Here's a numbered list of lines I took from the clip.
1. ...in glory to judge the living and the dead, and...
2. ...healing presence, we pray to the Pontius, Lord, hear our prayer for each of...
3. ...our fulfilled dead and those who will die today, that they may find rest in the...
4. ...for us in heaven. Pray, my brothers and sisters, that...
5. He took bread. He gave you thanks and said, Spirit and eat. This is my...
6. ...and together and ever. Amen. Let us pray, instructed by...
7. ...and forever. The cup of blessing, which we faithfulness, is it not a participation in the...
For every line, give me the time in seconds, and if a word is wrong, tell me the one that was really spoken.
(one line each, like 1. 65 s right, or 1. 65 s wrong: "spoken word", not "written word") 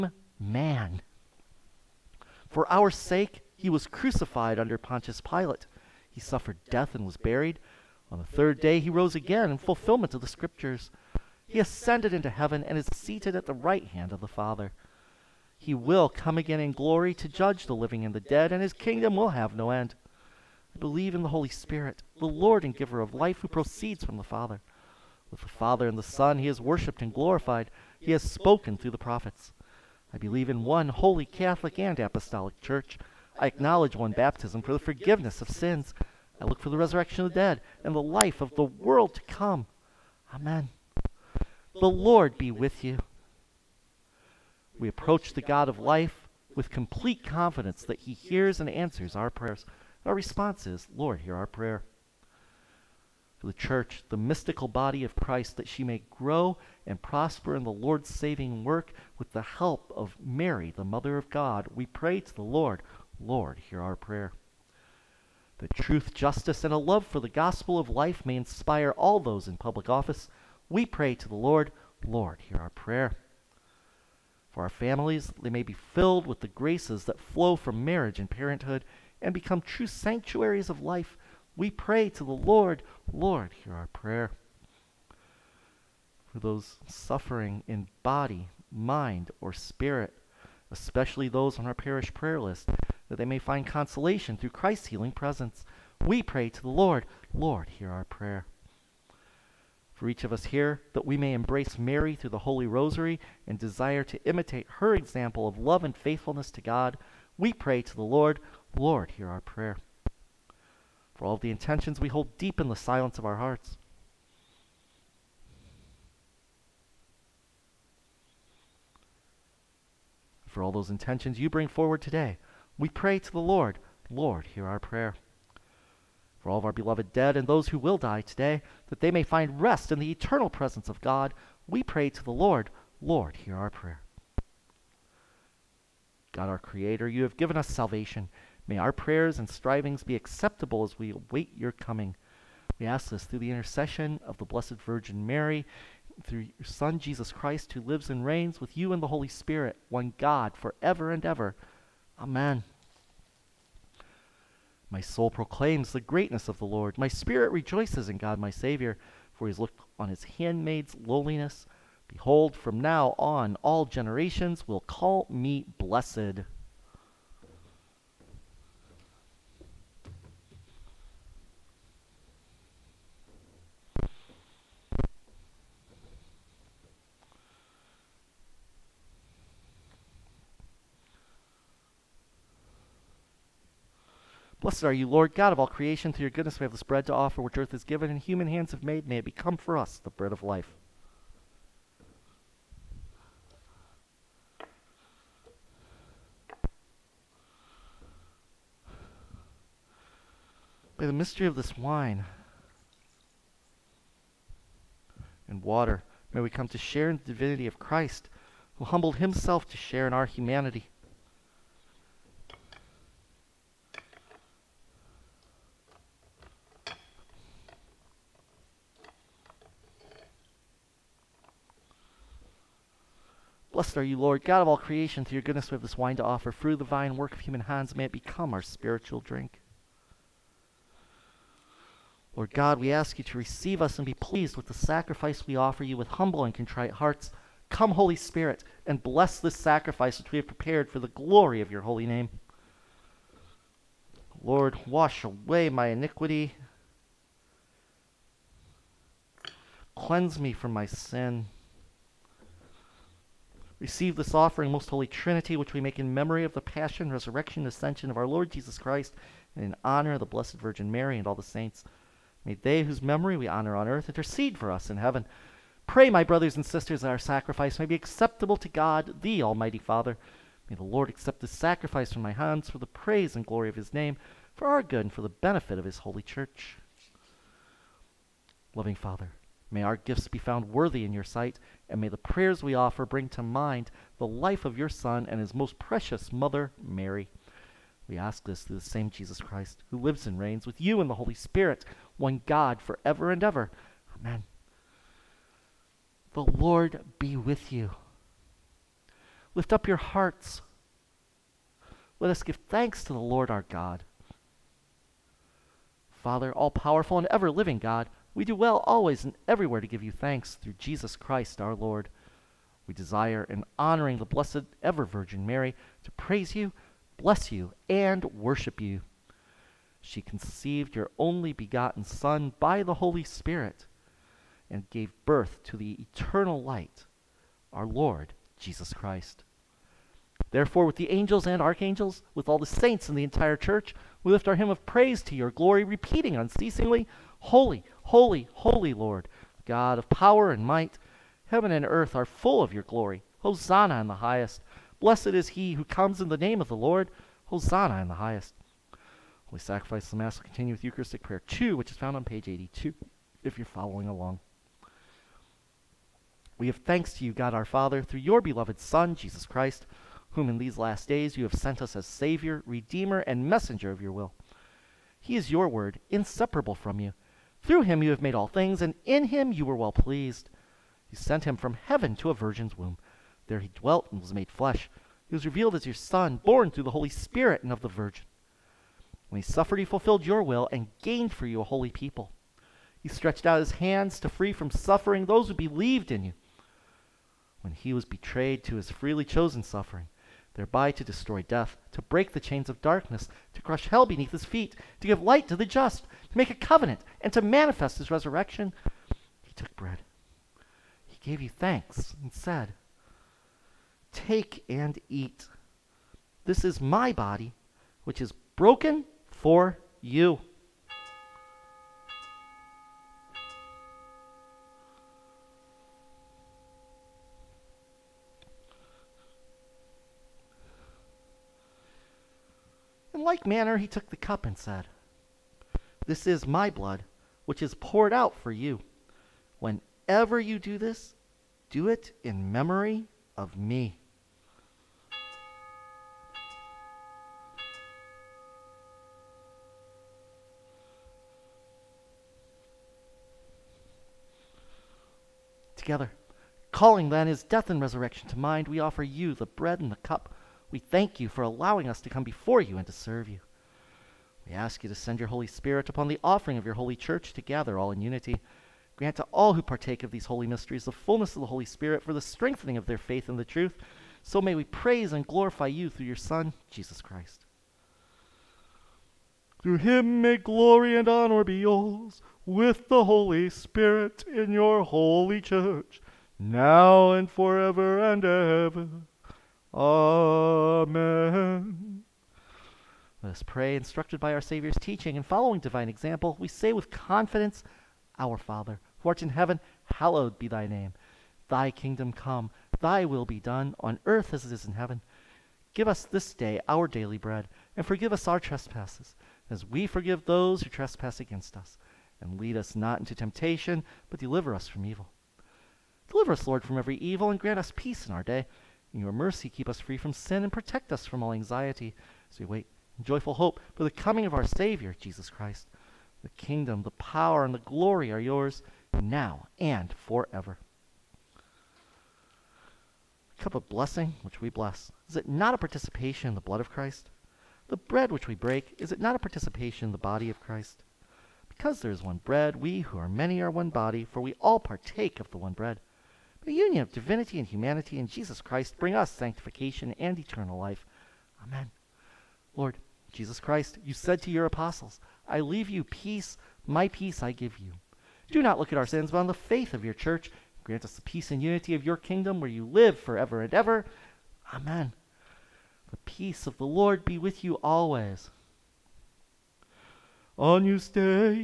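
1. 16 s right
2. 94 s wrong: "Lord", not "Pontius"
3. 126 s wrong: "beloved", not "fulfilled"
4. 264 s right
5. 399 s wrong: "Take", not "Spirit"
6. 477 s wrong: "forever", not "together"
7. 519 s wrong: "bless", not "faithfulness".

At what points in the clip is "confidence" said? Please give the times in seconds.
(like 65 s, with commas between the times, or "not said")
47 s, 486 s.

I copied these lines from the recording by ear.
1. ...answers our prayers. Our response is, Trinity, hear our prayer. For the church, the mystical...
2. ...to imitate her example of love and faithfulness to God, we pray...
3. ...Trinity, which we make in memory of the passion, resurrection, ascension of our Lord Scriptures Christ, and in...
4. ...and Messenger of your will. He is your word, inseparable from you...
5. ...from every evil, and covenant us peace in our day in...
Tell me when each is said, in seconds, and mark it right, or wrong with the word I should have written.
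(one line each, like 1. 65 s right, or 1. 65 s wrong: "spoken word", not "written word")
1. 48 s wrong: "Lord", not "Trinity"
2. 104 s right
3. 255 s wrong: "Jesus", not "Scriptures"
4. 363 s right
5. 506 s wrong: "grant", not "covenant".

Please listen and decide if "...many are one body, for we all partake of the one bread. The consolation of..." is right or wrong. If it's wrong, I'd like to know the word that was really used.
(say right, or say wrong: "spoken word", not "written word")
wrong: "union", not "consolation".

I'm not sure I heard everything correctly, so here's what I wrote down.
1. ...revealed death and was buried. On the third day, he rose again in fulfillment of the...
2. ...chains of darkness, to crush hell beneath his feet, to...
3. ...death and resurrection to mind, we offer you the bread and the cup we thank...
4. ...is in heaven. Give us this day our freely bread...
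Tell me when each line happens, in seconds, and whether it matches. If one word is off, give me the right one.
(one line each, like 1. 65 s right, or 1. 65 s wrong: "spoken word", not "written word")
1. 6 s wrong: "suffered", not "revealed"
2. 392 s right
3. 447 s right
4. 494 s wrong: "daily", not "freely".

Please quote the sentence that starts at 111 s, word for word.
For all the intentions we hold deep in the silence of our hearts.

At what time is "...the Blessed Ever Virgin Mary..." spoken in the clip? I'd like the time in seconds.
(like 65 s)
314 s.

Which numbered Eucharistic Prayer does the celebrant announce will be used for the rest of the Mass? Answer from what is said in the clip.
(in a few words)
Eucharistic Prayer 2.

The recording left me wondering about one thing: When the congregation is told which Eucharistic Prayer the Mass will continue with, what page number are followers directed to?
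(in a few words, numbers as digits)
82.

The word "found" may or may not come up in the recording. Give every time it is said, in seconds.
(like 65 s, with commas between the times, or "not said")
280 s, 351 s.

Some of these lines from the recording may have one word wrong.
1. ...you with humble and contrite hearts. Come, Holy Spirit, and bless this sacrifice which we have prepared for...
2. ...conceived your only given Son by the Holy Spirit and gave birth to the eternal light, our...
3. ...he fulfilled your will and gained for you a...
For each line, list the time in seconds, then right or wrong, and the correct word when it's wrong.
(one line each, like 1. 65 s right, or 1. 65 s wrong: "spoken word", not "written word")
1. 235 s right
2. 320 s wrong: "begotten", not "given"
3. 379 s right.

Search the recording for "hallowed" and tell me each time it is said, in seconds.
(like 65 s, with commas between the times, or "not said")
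489 s.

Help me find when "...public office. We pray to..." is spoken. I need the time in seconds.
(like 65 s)
69 s.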